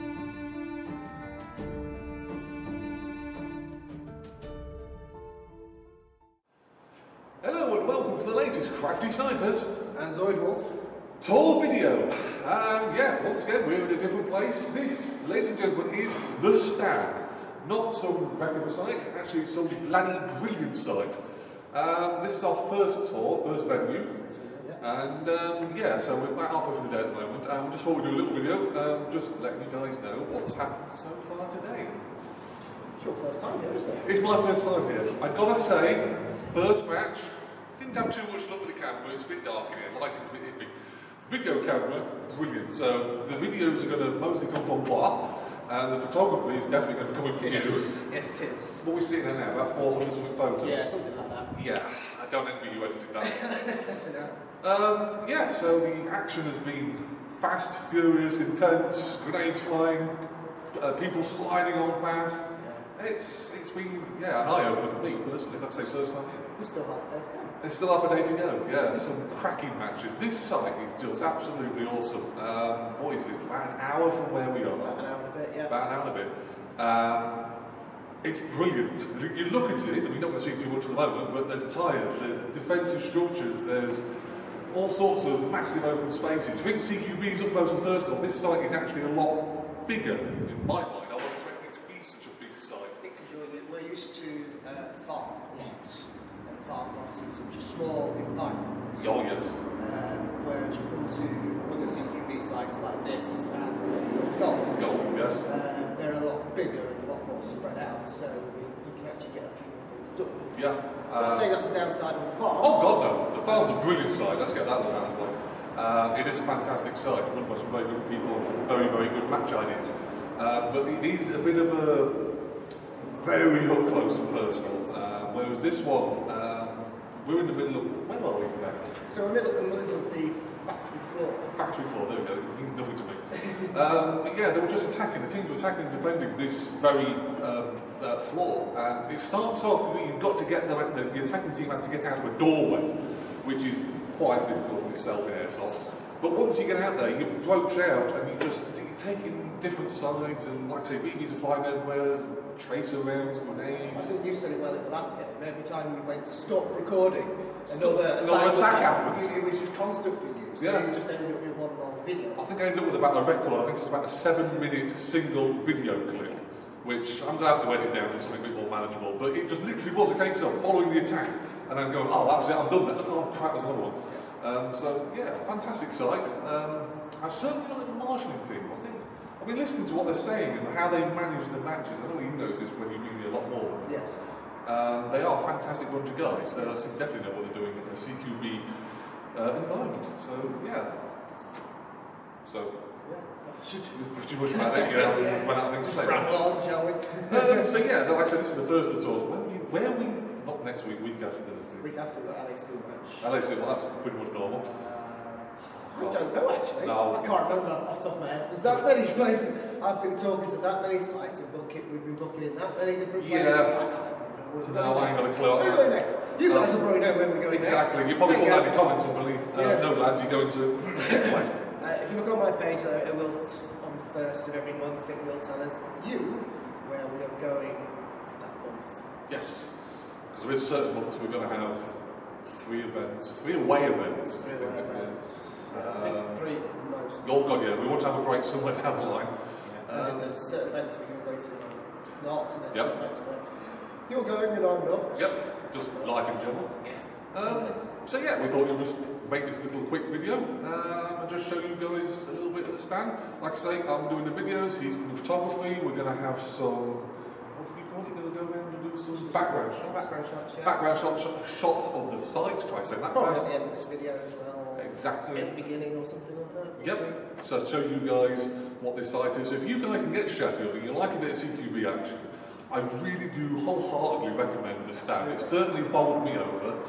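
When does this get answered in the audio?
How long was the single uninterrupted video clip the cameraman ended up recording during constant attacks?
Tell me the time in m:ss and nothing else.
2:44.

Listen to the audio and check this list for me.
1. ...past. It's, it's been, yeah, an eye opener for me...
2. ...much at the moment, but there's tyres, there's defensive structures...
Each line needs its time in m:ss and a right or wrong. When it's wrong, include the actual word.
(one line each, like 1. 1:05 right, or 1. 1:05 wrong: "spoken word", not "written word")
1. 1:02 right
2. 1:20 right.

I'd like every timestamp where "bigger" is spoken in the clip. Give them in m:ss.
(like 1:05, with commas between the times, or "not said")
1:29, 1:46.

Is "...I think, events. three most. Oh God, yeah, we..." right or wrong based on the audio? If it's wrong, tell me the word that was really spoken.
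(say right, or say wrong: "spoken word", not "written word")
right.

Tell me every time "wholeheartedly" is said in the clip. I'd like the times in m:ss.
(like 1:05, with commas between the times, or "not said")
4:33.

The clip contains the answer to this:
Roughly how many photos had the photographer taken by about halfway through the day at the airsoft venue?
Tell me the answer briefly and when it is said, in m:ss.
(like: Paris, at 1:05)
About 400, at 0:49.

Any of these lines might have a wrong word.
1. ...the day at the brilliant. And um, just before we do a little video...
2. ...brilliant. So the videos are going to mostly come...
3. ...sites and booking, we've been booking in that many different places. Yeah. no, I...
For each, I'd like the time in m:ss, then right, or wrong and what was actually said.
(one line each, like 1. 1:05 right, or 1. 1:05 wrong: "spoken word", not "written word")
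1. 0:26 wrong: "moment", not "brilliant"
2. 0:42 right
3. 3:31 right.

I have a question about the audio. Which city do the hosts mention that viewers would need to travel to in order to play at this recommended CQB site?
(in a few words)
Sheffield.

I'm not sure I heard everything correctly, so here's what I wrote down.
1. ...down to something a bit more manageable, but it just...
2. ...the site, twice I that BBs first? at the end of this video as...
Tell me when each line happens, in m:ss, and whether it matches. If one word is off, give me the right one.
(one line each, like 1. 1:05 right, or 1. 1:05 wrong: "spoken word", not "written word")
1. 2:47 right
2. 4:22 wrong: "Probably", not "BBs".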